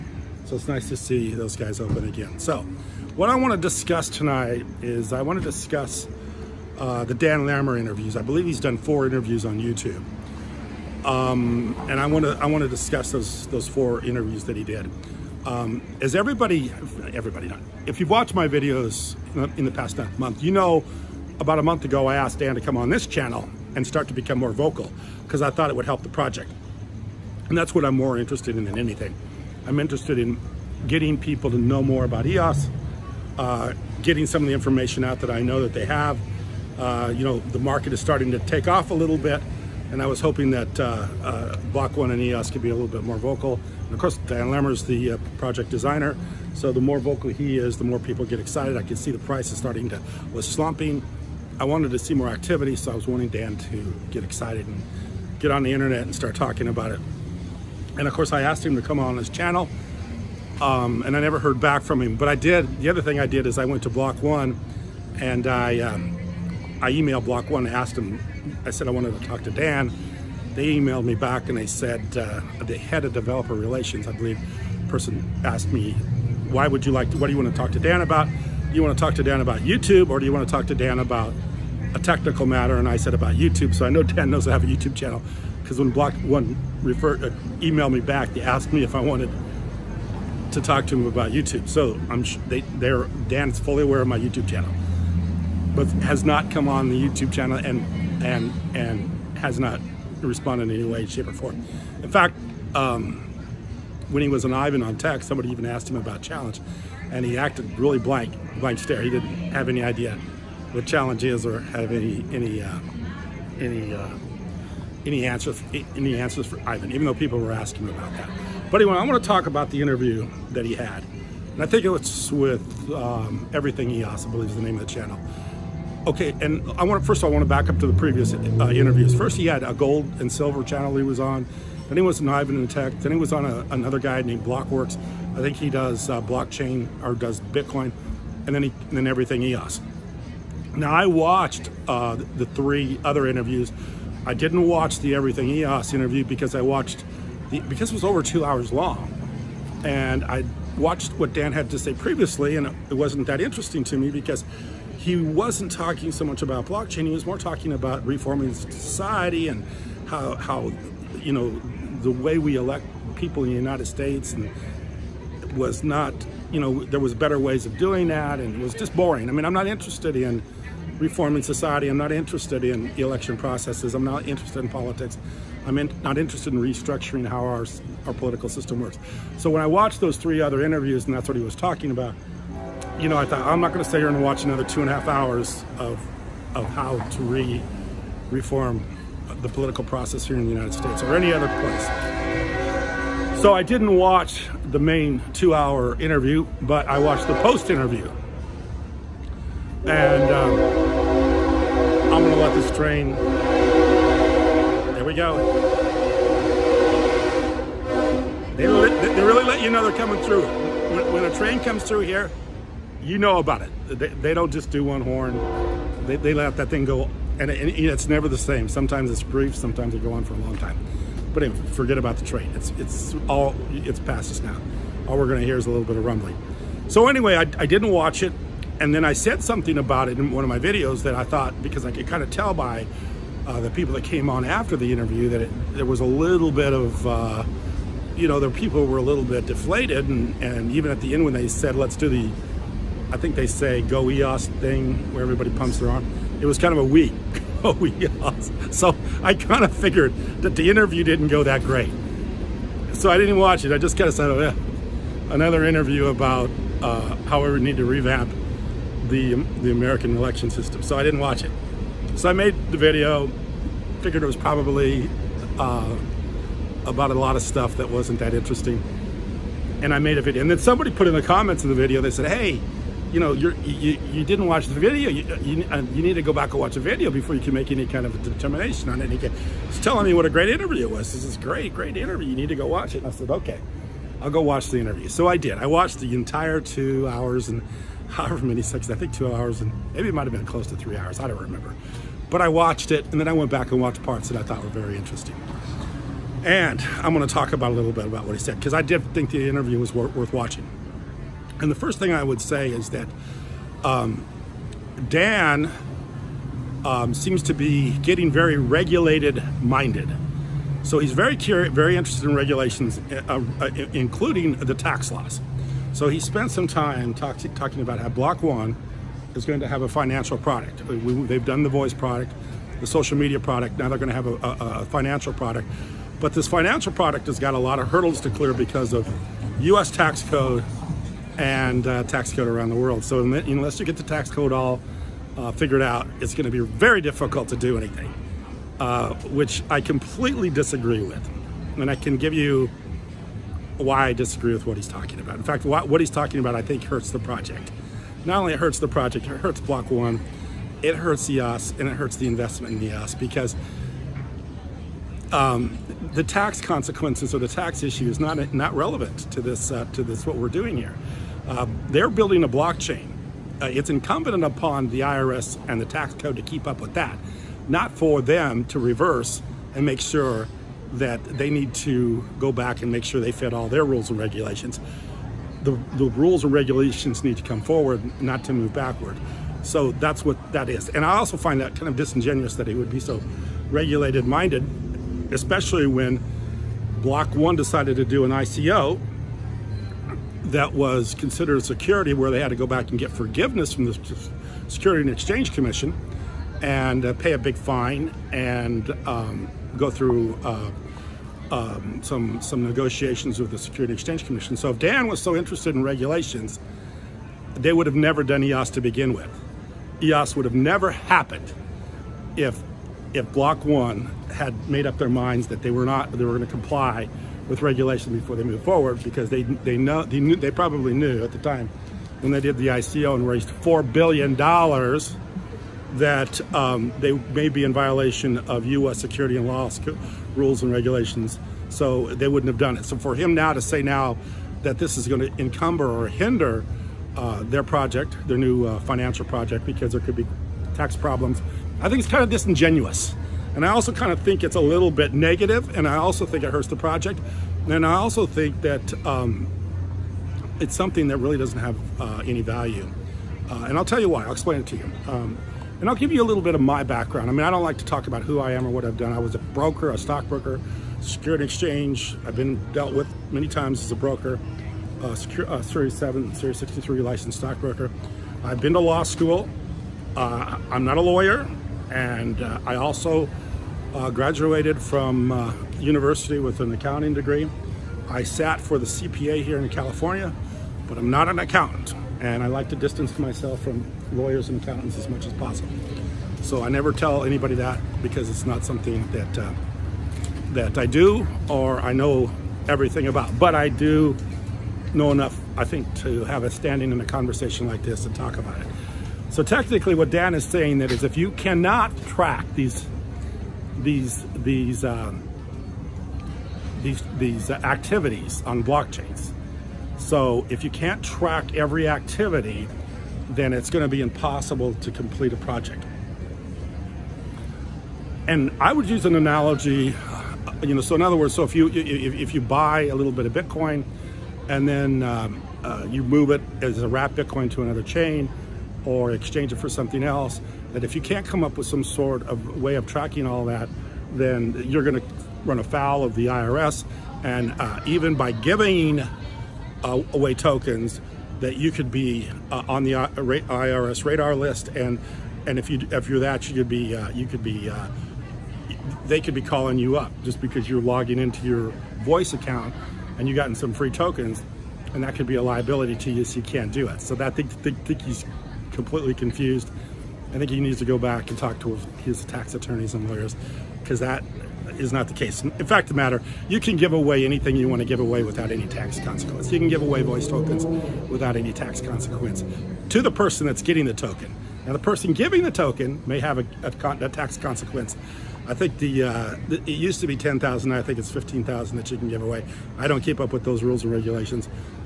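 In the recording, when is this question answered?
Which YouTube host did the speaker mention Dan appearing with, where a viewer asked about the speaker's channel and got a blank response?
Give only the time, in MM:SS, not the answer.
01:44.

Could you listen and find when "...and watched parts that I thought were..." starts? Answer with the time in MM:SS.
04:53.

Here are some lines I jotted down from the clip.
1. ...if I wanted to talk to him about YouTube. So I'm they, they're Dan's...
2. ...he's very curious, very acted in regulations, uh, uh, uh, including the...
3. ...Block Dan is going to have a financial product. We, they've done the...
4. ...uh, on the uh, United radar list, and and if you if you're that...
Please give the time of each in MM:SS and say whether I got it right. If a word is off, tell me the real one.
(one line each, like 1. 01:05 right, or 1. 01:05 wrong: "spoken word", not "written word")
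1. 01:28 right
2. 05:10 wrong: "interested", not "acted"
3. 05:18 wrong: "One", not "Dan"
4. 09:02 wrong: "IRS", not "United".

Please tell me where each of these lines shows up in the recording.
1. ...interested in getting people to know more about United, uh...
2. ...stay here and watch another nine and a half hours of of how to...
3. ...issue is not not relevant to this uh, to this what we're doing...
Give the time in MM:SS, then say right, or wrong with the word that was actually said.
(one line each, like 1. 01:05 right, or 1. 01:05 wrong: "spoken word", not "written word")
1. 00:29 wrong: "EOS", not "United"
2. 03:03 wrong: "two", not "nine"
3. 05:57 right.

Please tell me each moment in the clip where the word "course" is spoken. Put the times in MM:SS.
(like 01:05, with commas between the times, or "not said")
00:43, 00:58.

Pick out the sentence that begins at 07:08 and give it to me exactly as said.
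security and laws, rules and regulations.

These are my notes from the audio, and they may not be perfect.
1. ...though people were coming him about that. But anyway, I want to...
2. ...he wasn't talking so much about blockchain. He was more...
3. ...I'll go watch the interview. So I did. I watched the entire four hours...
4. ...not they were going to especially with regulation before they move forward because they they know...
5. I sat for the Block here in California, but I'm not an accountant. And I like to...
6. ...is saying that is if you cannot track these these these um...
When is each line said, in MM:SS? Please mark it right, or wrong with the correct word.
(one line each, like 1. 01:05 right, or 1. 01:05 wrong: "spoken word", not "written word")
1. 01:57 wrong: "asking", not "coming"
2. 02:34 right
3. 04:44 wrong: "two", not "four"
4. 06:55 wrong: "comply", not "especially"
5. 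07:58 wrong: "CPA", not "Block"
6. 08:20 right.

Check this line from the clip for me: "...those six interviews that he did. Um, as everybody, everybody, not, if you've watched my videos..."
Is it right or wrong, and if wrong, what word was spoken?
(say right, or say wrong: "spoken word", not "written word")
wrong: "four", not "six".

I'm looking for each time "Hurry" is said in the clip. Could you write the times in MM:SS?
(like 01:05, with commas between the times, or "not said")
not said.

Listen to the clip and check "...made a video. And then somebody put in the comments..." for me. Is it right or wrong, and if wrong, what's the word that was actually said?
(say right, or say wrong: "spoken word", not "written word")
right.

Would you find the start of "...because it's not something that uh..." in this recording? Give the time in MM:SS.
08:08.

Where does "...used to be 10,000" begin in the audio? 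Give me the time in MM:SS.
09:39.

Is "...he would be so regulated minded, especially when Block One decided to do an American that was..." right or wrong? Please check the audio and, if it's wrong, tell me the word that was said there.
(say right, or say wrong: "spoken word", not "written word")
wrong: "ICO", not "American".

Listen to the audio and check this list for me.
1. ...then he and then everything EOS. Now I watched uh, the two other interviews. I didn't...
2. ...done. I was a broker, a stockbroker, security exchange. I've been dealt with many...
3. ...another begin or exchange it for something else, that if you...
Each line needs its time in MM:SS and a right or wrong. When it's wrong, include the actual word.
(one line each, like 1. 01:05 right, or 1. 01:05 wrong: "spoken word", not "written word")
1. 02:18 wrong: "three", not "two"
2. 07:38 right
3. 08:47 wrong: "chain", not "begin".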